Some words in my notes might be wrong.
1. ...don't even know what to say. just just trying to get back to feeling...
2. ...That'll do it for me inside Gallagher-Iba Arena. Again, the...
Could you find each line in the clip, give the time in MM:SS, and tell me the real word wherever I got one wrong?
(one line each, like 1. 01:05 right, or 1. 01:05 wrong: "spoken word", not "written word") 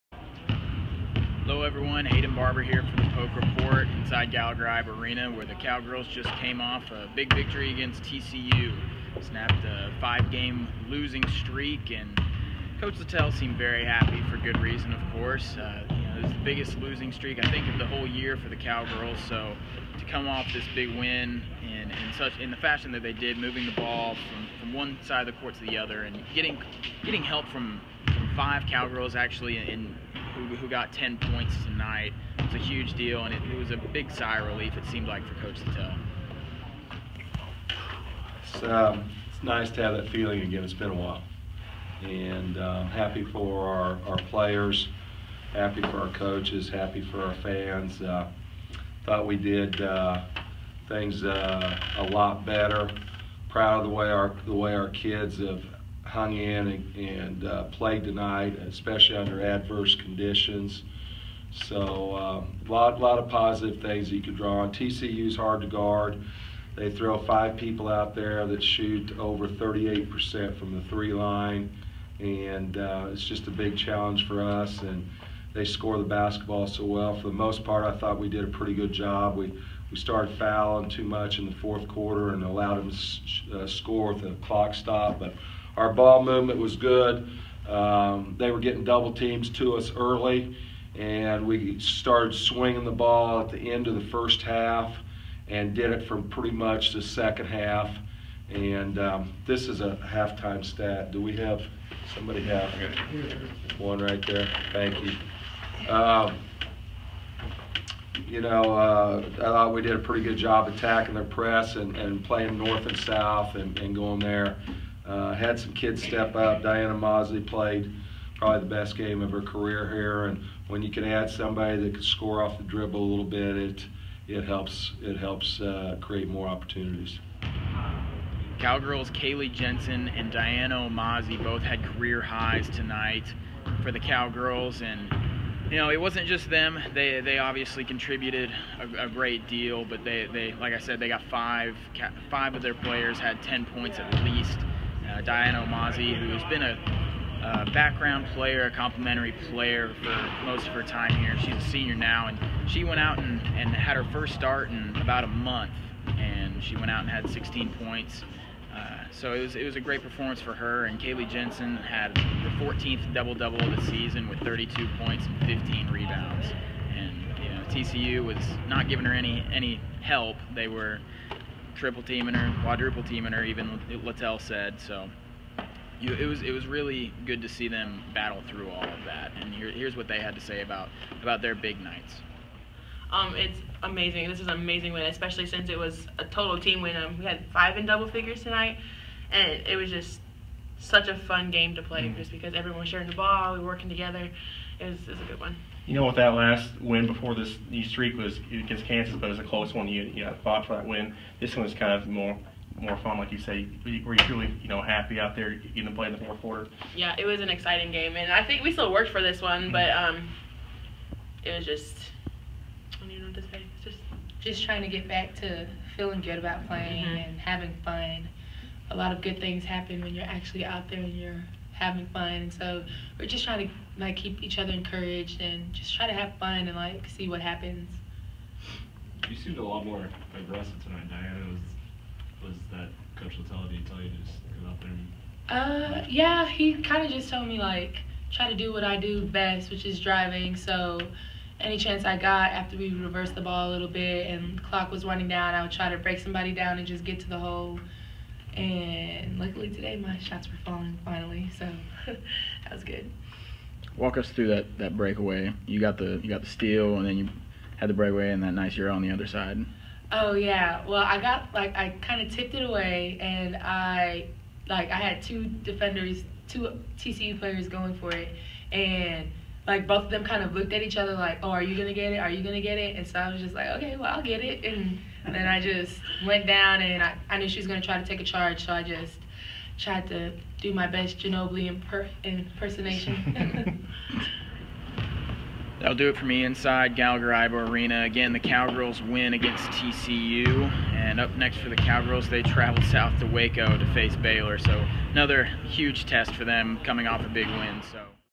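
1. 03:33 right
2. 04:45 right.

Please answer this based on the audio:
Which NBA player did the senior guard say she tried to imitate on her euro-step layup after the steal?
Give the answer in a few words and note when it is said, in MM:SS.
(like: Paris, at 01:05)
Ginobili, at 04:41.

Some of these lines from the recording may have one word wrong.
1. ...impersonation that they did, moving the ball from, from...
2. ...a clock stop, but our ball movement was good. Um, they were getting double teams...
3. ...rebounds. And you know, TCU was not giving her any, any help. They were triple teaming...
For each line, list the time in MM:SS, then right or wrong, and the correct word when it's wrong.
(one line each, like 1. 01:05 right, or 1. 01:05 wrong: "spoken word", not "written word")
1. 00:22 wrong: "fashion", not "impersonation"
2. 01:24 right
3. 02:45 right.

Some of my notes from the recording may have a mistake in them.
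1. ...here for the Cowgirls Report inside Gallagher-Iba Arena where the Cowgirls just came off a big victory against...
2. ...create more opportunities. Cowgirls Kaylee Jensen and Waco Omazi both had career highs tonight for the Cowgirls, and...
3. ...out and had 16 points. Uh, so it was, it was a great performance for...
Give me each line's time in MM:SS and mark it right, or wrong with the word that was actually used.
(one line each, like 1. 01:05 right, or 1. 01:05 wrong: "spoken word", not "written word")
1. 00:02 wrong: "Poke", not "Cowgirls"
2. 02:06 wrong: "Diana", not "Waco"
3. 02:36 right.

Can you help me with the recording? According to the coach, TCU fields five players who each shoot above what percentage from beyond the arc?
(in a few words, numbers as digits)
38%.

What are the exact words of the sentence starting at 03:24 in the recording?
Were you truly, you know, happy out there getting to play in the fourth quarter?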